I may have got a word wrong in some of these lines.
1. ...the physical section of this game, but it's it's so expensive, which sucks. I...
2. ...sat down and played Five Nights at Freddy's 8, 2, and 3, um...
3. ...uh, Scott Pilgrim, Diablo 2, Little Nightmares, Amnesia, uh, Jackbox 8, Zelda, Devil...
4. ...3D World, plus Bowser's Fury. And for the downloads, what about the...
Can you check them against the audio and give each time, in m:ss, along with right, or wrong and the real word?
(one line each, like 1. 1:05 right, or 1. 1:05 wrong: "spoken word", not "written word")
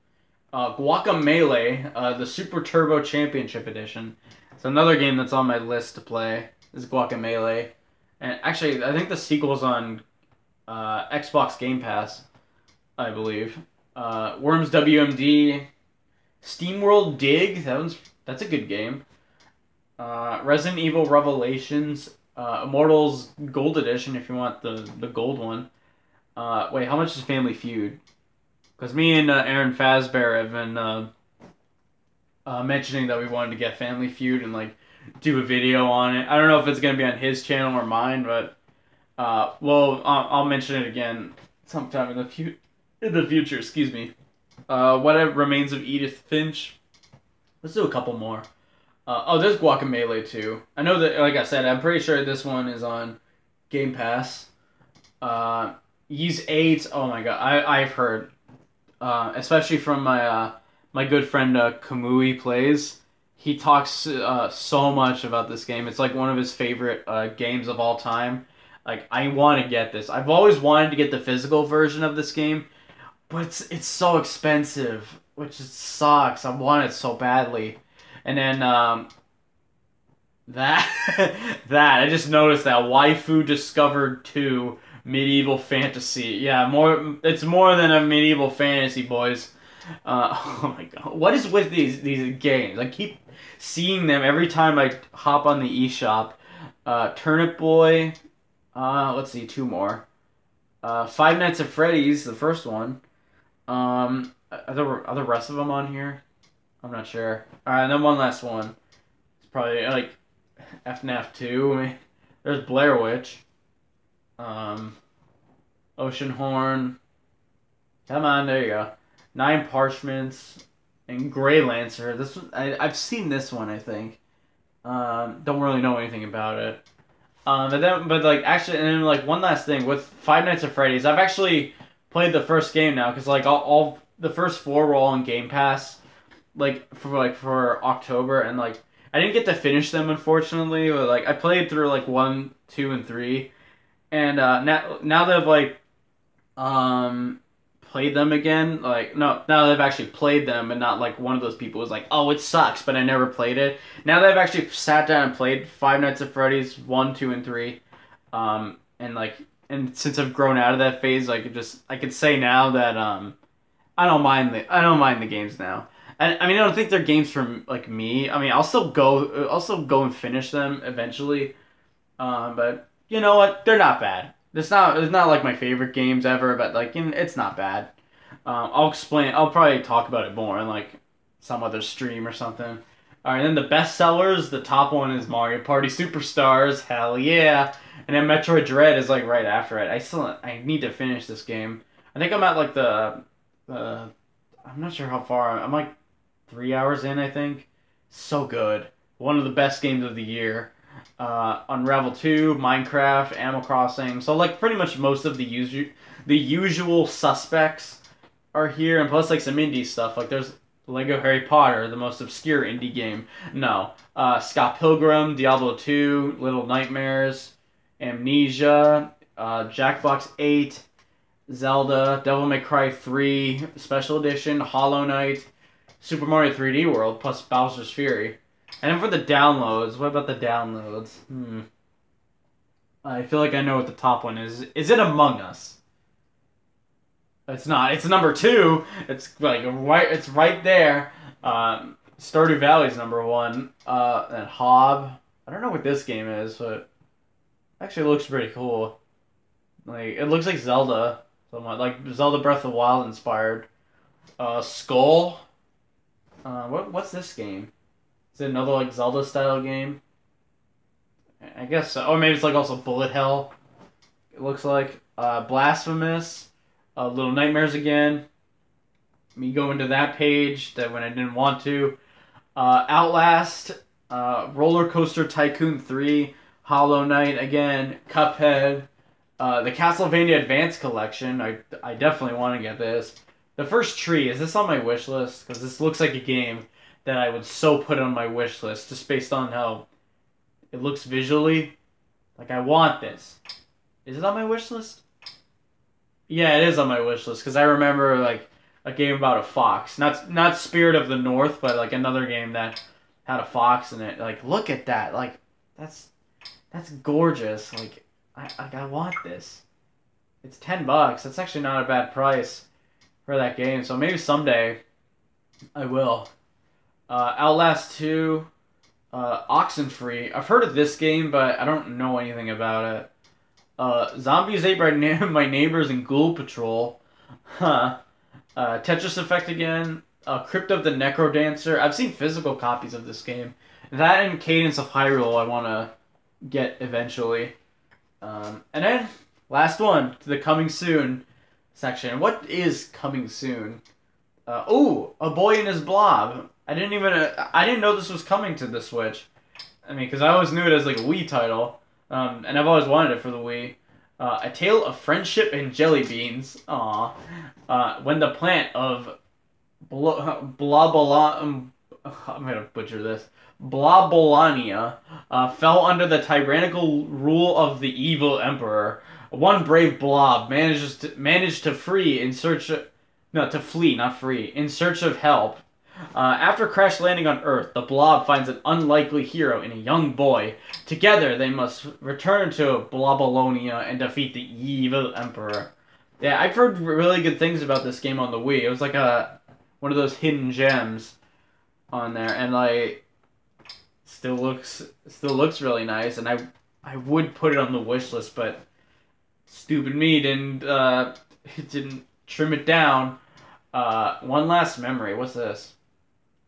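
1. 1:11 wrong: "version", not "section"
2. 2:34 wrong: "1", not "8"
3. 3:34 right
4. 3:46 right.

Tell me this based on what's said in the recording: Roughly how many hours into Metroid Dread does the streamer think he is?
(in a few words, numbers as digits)
3 hours.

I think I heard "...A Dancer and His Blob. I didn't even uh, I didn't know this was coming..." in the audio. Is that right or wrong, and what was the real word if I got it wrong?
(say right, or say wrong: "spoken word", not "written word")
wrong: "Boy", not "Dancer".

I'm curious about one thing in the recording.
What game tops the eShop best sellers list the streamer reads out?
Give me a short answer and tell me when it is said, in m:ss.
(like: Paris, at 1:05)
Mario Party Superstars, at 3:05.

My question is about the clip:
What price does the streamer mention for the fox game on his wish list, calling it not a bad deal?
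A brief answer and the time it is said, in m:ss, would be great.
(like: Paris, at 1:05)
$10, at 5:10.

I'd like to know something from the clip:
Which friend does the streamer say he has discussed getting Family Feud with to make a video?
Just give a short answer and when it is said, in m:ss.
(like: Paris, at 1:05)
Aaron Fazbear, at 0:29.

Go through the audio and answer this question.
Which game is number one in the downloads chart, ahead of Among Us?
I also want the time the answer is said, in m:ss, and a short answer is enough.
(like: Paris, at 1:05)
Stardew Valley, at 4:02.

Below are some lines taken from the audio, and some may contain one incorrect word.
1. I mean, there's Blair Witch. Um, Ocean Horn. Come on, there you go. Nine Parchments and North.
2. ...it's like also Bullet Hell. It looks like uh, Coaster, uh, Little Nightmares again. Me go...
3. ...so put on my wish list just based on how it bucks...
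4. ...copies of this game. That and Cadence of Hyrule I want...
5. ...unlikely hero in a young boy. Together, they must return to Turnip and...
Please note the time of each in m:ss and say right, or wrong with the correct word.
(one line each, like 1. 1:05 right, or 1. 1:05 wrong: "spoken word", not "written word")
1. 1:51 wrong: "Gleylancer", not "North"
2. 4:22 wrong: "Blasphemous", not "Coaster"
3. 4:47 wrong: "looks", not "bucks"
4. 5:32 right
5. 6:18 wrong: "Blobalonia", not "Turnip".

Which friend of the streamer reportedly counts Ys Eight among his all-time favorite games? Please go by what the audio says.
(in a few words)
Kamui.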